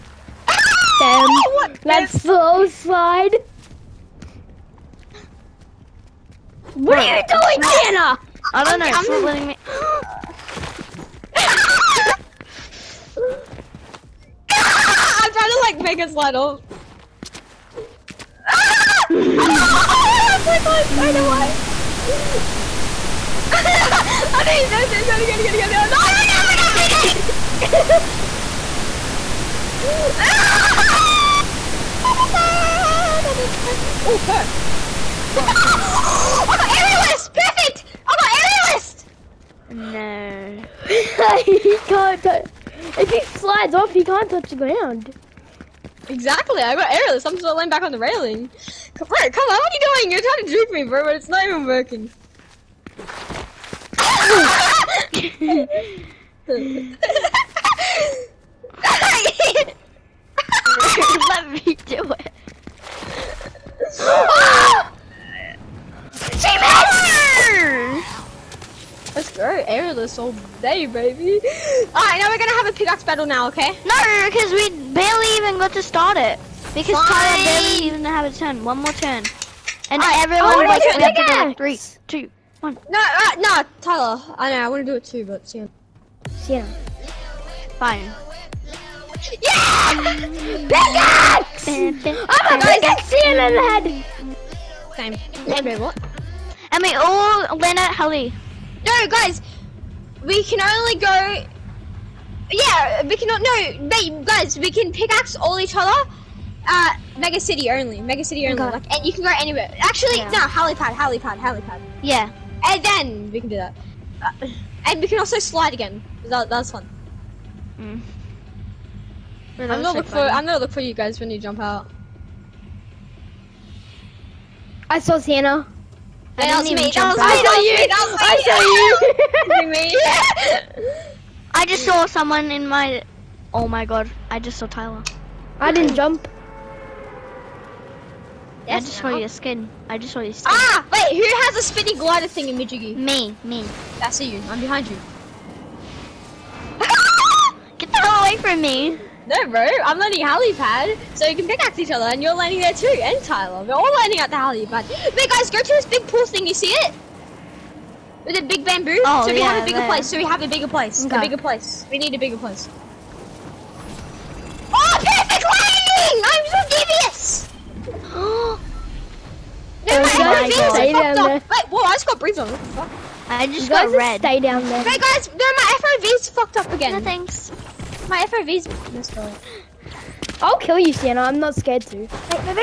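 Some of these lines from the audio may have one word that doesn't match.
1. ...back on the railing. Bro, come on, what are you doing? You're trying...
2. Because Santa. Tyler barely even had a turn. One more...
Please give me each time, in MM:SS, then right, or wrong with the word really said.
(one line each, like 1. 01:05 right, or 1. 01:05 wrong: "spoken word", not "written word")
1. 00:47 right
2. 01:16 wrong: "Fine", not "Santa".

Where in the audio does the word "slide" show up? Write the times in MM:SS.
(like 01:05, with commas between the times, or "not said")
00:02, 00:16, 00:43, 01:55.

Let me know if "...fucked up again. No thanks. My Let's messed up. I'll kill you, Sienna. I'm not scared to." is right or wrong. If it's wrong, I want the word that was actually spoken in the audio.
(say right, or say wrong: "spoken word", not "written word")
wrong: "FOV", not "Let".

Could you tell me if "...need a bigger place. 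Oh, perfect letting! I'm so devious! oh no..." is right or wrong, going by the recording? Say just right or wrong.
wrong.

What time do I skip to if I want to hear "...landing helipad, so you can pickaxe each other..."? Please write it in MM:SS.
02:29.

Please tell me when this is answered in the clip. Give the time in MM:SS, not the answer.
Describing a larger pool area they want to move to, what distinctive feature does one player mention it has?
02:38.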